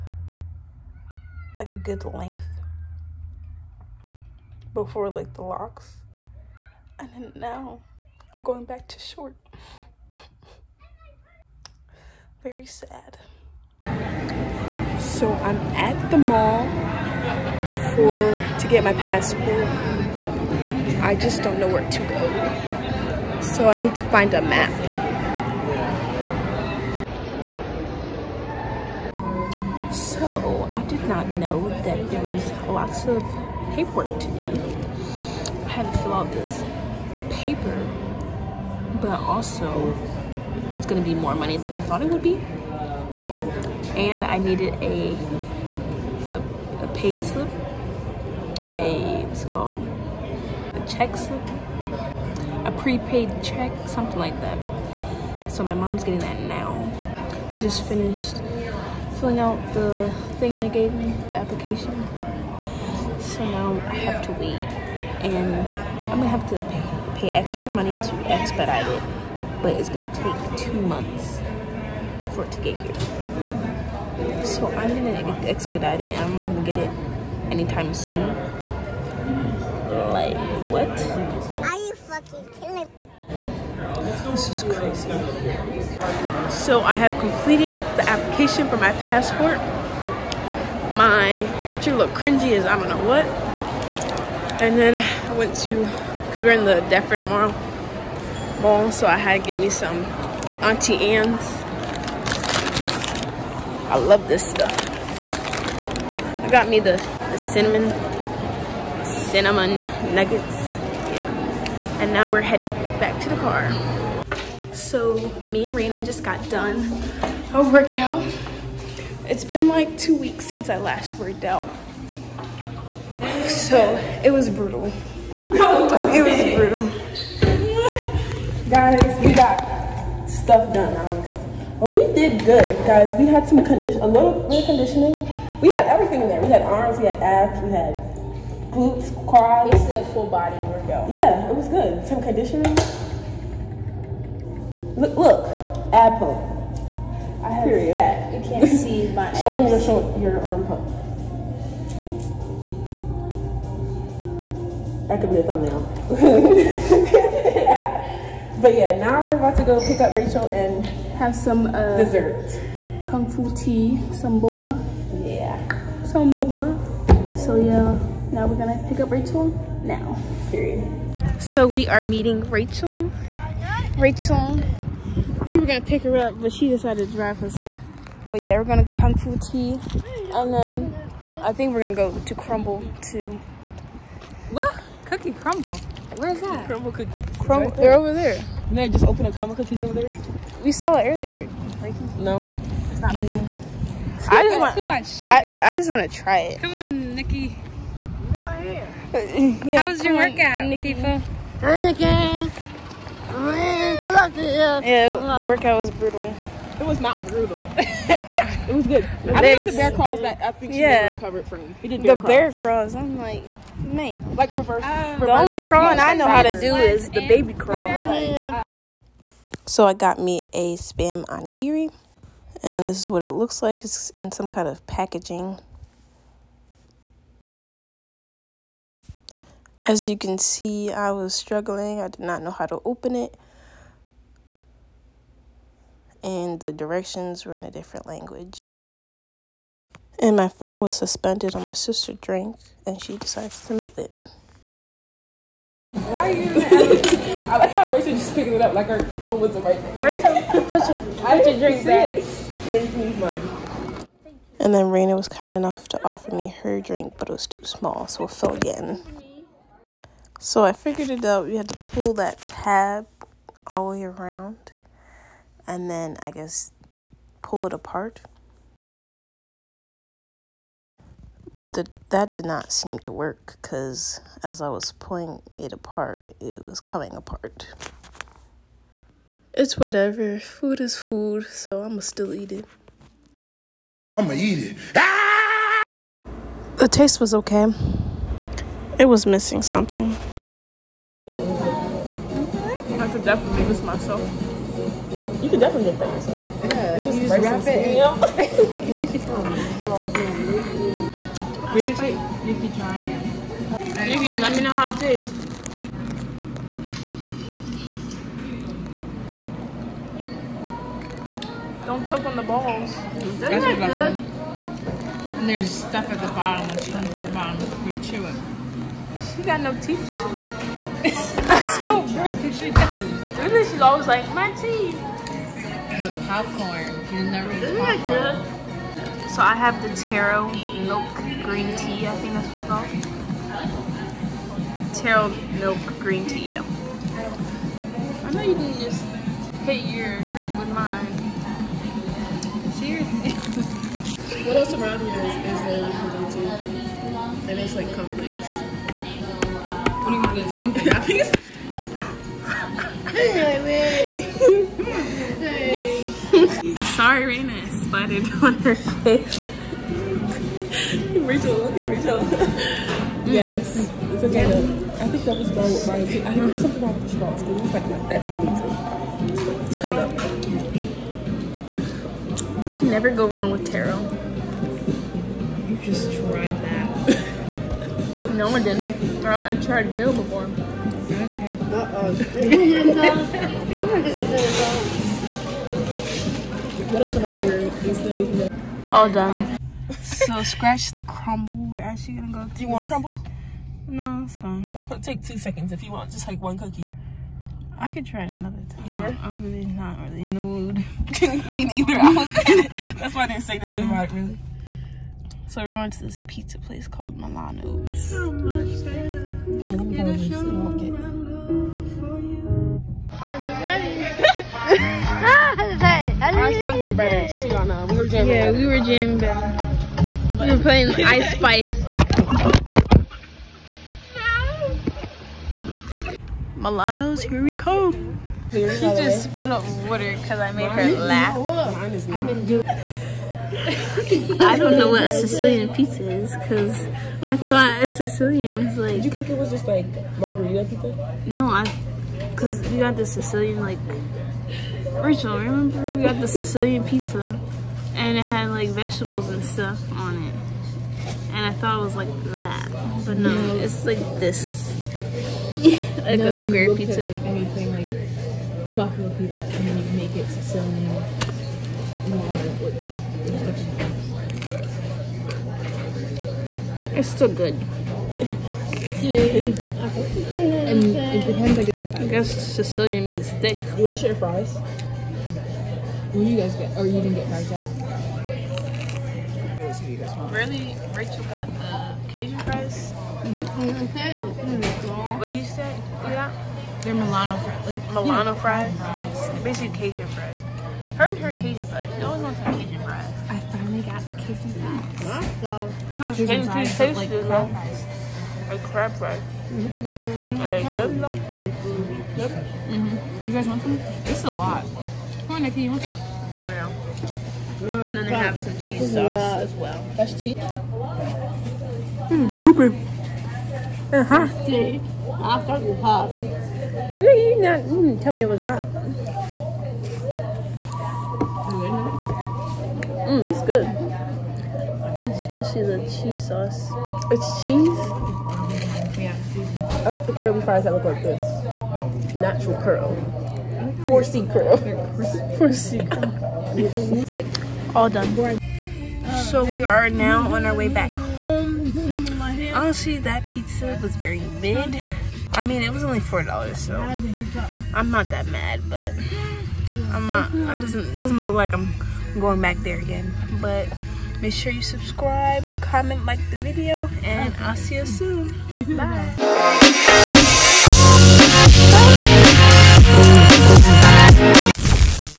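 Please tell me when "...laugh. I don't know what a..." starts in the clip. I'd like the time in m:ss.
7:10.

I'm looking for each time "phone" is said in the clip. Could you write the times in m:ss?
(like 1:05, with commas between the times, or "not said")
4:00, 4:09.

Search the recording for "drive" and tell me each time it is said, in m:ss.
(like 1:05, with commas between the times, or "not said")
2:57.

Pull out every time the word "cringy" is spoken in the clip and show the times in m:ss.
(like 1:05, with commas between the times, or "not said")
1:32.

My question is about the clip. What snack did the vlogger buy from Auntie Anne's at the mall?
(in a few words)
cinnamon nuggets.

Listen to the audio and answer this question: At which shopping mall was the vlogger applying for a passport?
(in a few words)
Deptford Mall.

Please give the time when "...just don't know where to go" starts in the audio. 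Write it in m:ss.
0:21.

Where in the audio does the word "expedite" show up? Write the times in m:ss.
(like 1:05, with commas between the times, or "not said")
1:08, 1:15.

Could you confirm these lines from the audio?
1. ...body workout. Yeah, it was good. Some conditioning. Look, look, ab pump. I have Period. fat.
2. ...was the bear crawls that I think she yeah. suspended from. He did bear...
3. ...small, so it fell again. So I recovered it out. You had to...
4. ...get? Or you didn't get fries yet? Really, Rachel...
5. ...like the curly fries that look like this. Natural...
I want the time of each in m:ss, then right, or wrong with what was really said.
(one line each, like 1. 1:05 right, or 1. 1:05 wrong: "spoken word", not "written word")
1. 2:20 right
2. 3:29 wrong: "recovered", not "suspended"
3. 4:17 wrong: "figured", not "recovered"
4. 7:56 right
5. 8:49 right.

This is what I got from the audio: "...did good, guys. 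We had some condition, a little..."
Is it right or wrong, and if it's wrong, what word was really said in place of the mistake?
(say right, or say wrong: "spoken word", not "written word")
right.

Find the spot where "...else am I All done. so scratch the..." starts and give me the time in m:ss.
6:27.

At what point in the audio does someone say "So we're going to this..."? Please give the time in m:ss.
6:45.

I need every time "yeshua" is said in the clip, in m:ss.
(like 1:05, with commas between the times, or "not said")
not said.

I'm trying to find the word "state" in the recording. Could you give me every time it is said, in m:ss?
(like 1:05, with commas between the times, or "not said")
not said.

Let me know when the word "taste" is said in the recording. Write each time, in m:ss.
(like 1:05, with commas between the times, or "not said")
4:46, 5:04.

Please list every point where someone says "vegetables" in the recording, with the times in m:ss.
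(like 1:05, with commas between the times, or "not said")
7:28.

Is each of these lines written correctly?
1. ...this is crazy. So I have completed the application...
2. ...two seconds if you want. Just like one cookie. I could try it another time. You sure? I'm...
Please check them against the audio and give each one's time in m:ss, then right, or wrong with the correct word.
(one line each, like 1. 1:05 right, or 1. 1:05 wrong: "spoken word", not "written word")
1. 1:24 right
2. 6:35 right.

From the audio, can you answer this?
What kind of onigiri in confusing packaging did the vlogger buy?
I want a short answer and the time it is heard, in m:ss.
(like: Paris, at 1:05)
spam, at 3:40.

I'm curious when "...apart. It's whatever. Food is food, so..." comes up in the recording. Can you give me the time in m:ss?
4:37.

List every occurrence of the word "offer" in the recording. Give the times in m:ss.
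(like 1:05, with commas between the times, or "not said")
4:16.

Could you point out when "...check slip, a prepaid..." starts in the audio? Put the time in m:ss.
0:50.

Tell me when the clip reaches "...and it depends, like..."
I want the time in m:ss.
7:50.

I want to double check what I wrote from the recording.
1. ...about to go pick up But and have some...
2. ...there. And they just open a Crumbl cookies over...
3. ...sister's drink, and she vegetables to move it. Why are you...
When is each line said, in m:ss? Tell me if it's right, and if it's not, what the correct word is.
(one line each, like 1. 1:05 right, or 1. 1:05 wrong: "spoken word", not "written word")
1. 2:39 wrong: "Rachel", not "But"
2. 3:08 right
3. 4:01 wrong: "decides", not "vegetables".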